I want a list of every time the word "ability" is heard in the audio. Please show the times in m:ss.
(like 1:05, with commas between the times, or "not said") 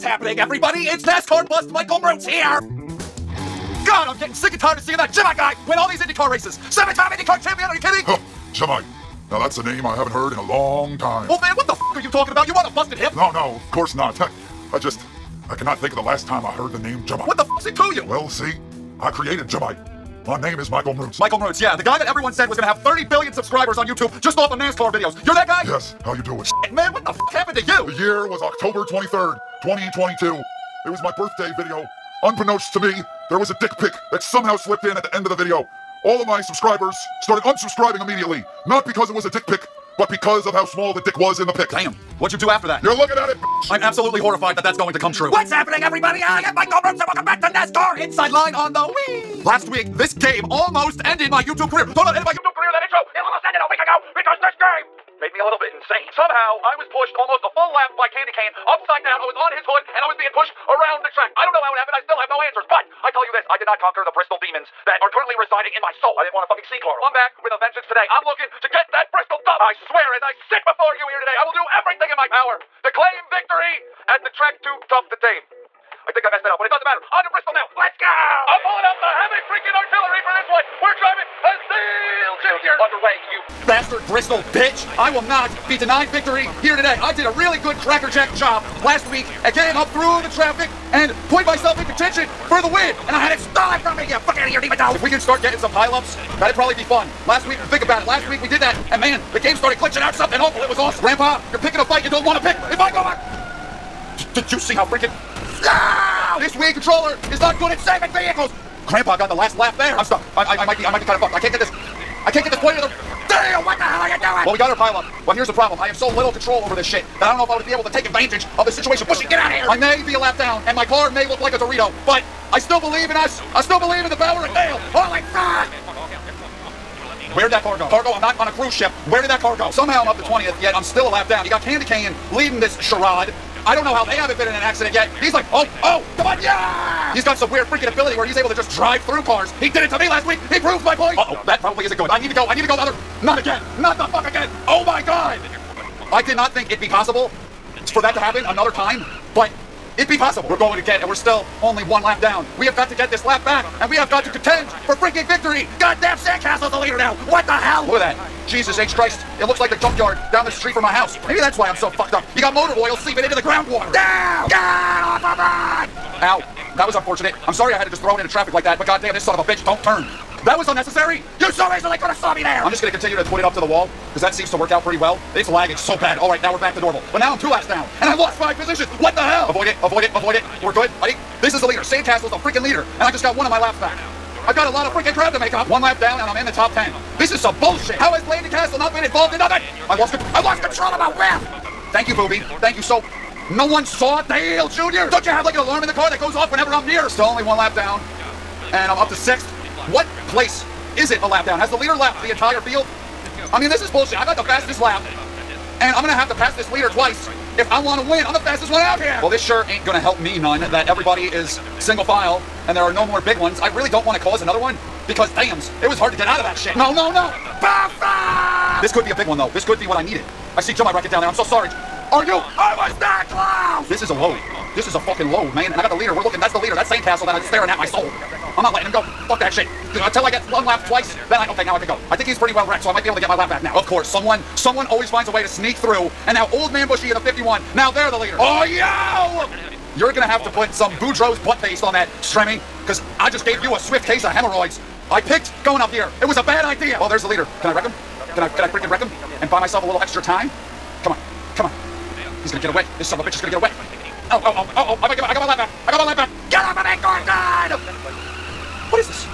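2:17.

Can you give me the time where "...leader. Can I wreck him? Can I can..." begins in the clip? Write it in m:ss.
4:07.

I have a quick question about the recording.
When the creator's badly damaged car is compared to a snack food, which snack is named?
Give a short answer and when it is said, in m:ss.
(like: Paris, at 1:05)
Dorito, at 2:01.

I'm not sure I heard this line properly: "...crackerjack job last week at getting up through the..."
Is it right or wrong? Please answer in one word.
right.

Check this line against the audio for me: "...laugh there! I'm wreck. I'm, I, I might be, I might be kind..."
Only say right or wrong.
wrong.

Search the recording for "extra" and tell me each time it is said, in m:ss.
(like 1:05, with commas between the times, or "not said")
4:10.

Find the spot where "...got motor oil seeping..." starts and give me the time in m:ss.
2:42.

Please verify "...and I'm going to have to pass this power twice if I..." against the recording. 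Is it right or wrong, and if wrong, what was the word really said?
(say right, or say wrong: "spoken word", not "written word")
wrong: "leader", not "power".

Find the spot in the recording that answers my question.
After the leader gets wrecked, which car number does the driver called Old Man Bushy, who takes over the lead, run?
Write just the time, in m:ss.
3:57.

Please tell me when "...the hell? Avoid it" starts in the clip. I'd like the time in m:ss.
2:59.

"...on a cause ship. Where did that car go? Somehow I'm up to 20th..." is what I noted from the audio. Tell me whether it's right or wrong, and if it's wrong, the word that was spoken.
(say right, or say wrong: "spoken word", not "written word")
wrong: "cruise", not "cause".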